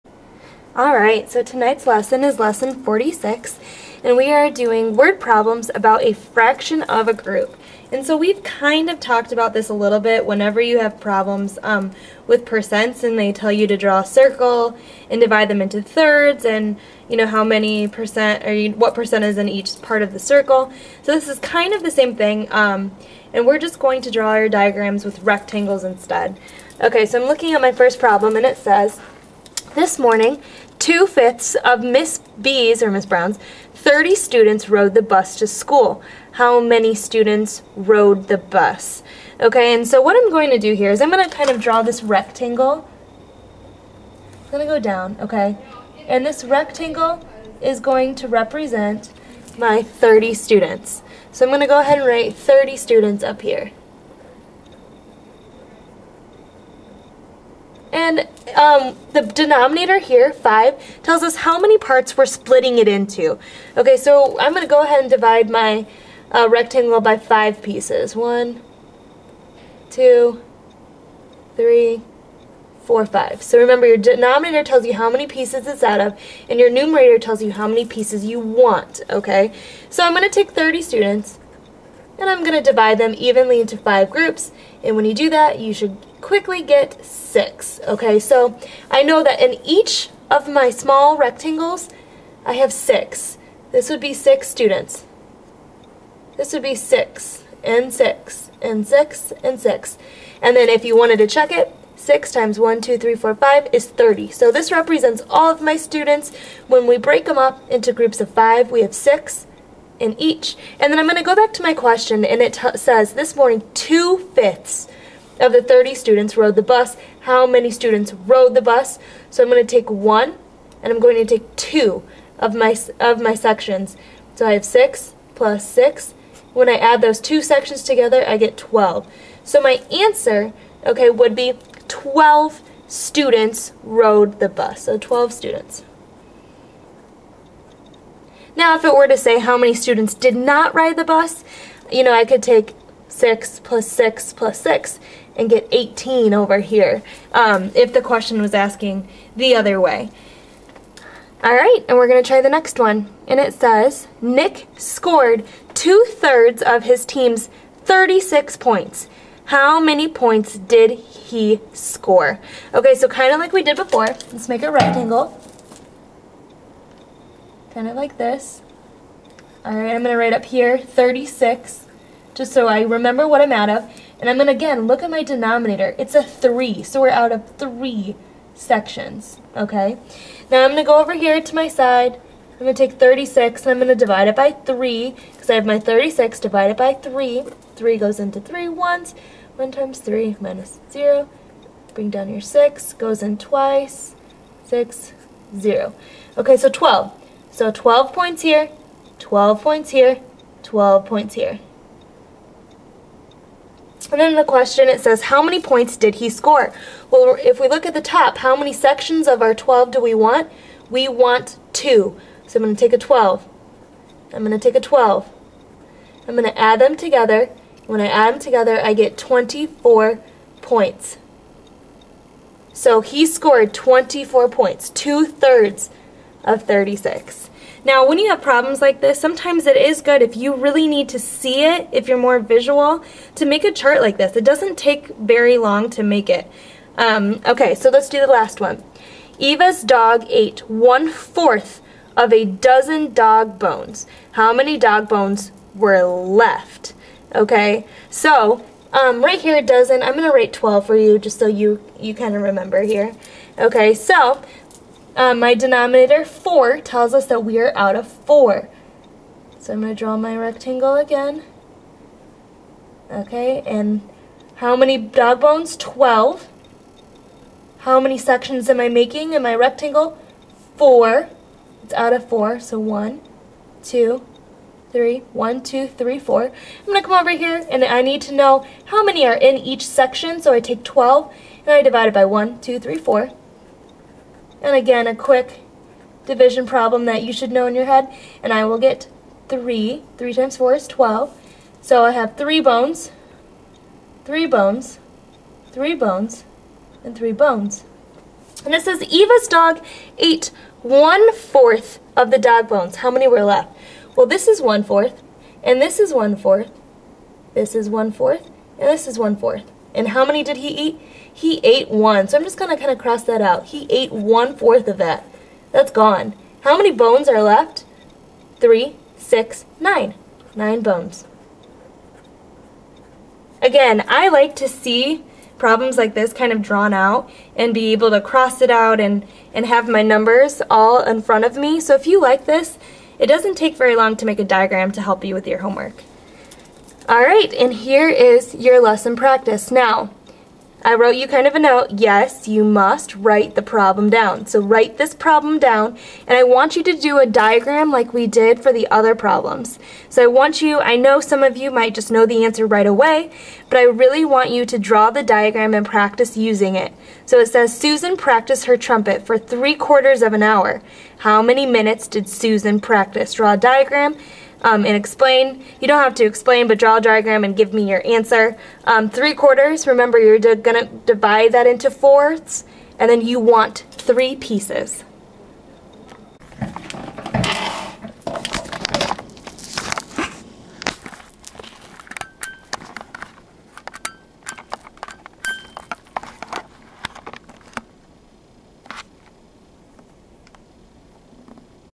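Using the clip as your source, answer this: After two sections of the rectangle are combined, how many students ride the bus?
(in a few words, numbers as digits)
12.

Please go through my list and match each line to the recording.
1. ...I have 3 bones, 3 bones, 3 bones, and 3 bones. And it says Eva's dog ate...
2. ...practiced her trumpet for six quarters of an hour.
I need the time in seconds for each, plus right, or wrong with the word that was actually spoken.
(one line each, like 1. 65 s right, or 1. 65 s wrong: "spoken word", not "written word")
1. 292 s right
2. 358 s wrong: "three", not "six".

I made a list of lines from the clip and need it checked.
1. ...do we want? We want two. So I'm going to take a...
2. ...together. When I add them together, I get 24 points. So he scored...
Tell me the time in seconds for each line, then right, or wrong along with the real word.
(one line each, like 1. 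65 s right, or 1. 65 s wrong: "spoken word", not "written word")
1. 209 s right
2. 216 s right.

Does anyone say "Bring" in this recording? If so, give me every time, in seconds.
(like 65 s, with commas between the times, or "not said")
191 s.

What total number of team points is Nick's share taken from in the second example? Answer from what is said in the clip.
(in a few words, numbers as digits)
36.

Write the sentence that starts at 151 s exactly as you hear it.
All right, and we're going to try the next one.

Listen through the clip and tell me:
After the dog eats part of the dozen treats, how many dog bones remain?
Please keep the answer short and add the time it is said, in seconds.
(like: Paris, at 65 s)
9, at 320 s.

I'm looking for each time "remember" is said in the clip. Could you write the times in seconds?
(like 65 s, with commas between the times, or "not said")
73 s, 172 s, 252 s, 369 s.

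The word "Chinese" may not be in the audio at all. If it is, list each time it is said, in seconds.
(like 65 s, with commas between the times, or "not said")
not said.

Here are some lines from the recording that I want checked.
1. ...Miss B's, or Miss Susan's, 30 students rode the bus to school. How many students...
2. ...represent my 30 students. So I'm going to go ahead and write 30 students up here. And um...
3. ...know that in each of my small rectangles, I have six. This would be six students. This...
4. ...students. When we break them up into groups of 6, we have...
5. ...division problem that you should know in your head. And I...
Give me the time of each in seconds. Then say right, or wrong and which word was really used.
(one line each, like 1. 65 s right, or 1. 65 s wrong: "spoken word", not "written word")
1. 31 s wrong: "Brown", not "Susan"
2. 48 s right
3. 89 s right
4. 105 s wrong: "5", not "6"
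5. 286 s right.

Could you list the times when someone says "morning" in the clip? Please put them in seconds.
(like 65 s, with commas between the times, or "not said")
29 s, 113 s.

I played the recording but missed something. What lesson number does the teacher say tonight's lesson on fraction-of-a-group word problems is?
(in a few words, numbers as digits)
46.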